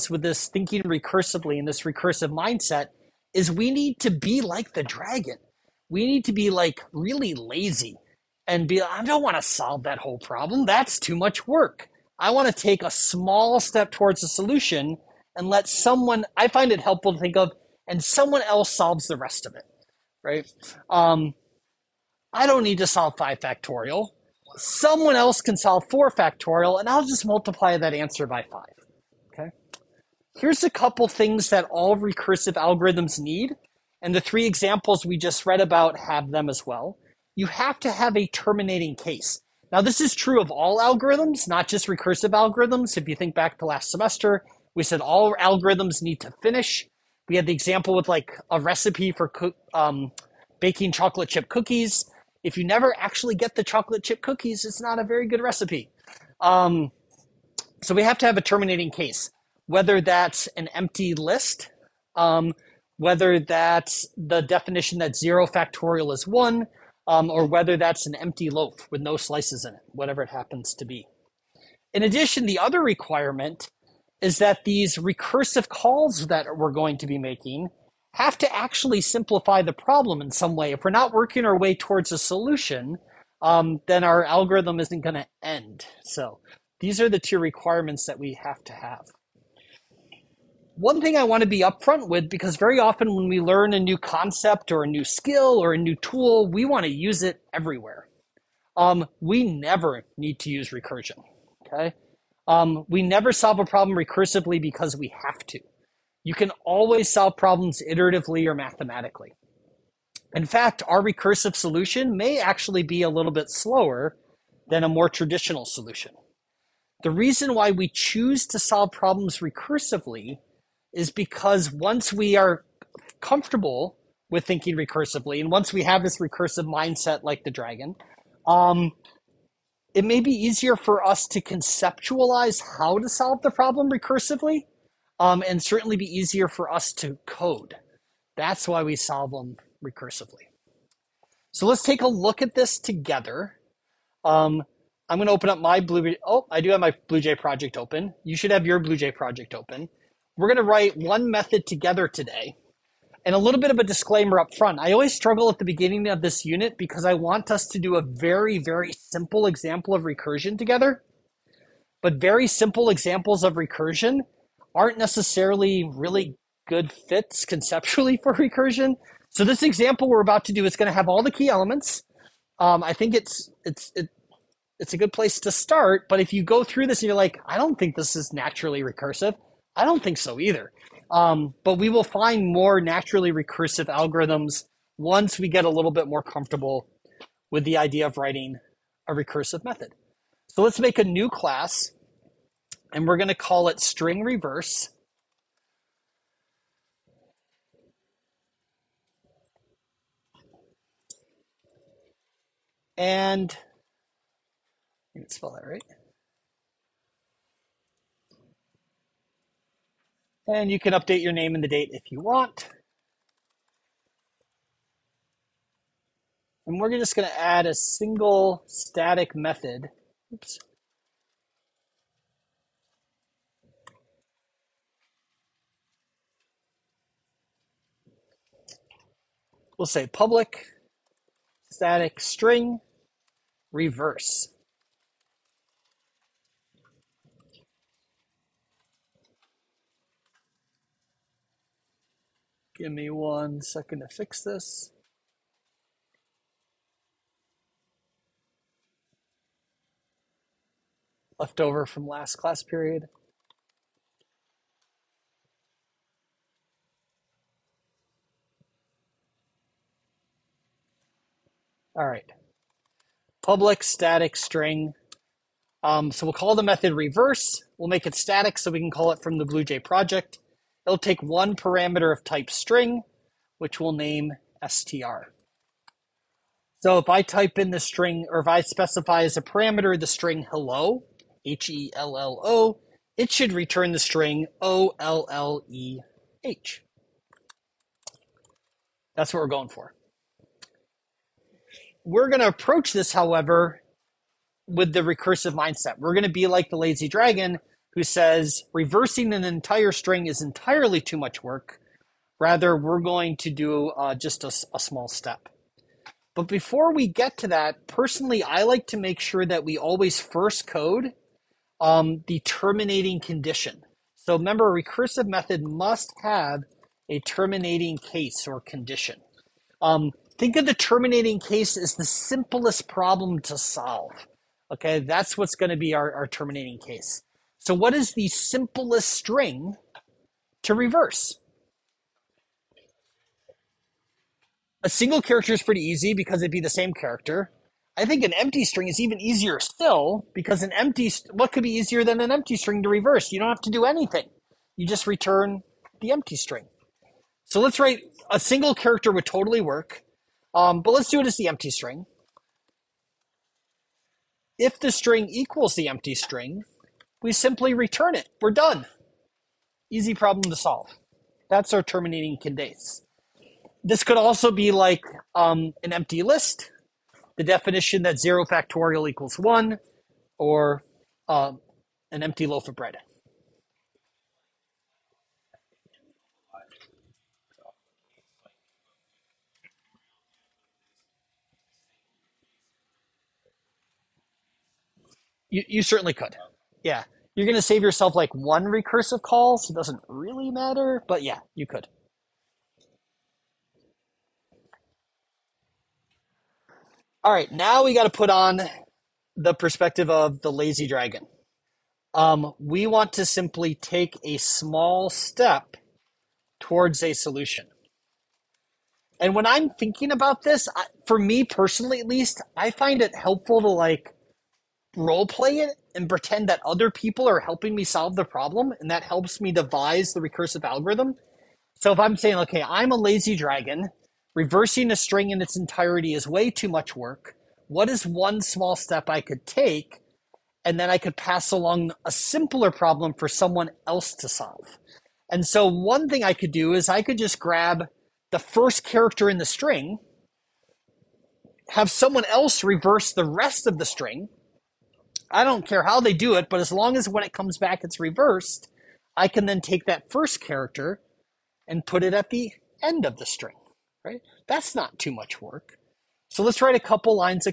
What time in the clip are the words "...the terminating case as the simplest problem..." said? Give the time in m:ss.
5:20.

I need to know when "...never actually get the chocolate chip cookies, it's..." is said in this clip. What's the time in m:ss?
0:52.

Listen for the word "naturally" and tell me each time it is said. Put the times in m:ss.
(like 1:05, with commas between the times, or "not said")
2:58, 3:02.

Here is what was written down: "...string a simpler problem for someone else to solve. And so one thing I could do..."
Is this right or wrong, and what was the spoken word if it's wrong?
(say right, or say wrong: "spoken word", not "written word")
wrong: "along", not "string".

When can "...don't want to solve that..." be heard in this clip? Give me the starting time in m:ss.
0:09.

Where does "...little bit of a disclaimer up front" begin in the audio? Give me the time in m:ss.
2:33.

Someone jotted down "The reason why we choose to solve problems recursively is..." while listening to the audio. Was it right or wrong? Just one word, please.
right.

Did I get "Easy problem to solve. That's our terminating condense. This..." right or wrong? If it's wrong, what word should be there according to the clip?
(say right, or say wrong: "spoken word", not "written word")
right.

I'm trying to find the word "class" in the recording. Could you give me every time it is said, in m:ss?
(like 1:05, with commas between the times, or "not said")
3:11, 4:12.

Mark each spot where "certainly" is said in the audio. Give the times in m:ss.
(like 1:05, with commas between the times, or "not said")
2:15, 6:25.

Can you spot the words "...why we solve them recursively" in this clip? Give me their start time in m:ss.
2:18.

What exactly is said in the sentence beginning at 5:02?
Rather, we're going to do uh, just a, a small step.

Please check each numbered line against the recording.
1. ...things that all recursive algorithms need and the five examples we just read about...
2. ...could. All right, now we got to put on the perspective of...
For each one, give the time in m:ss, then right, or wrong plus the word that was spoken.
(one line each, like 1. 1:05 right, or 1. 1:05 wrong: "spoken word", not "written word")
1. 0:31 wrong: "three", not "five"
2. 6:31 right.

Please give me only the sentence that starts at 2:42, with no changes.
But very simple examples of recursion aren't necessarily really good fits conceptually for recursion.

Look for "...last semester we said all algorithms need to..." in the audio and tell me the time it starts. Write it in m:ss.
0:43.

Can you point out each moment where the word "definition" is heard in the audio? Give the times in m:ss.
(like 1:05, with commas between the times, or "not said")
1:04, 6:07.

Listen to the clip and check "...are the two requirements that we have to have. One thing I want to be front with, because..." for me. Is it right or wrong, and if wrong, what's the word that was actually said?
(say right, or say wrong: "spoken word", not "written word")
wrong: "upfront", not "front".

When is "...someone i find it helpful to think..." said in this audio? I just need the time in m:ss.
0:15.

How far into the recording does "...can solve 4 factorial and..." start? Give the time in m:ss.
0:25.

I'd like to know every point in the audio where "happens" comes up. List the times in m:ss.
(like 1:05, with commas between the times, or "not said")
1:10.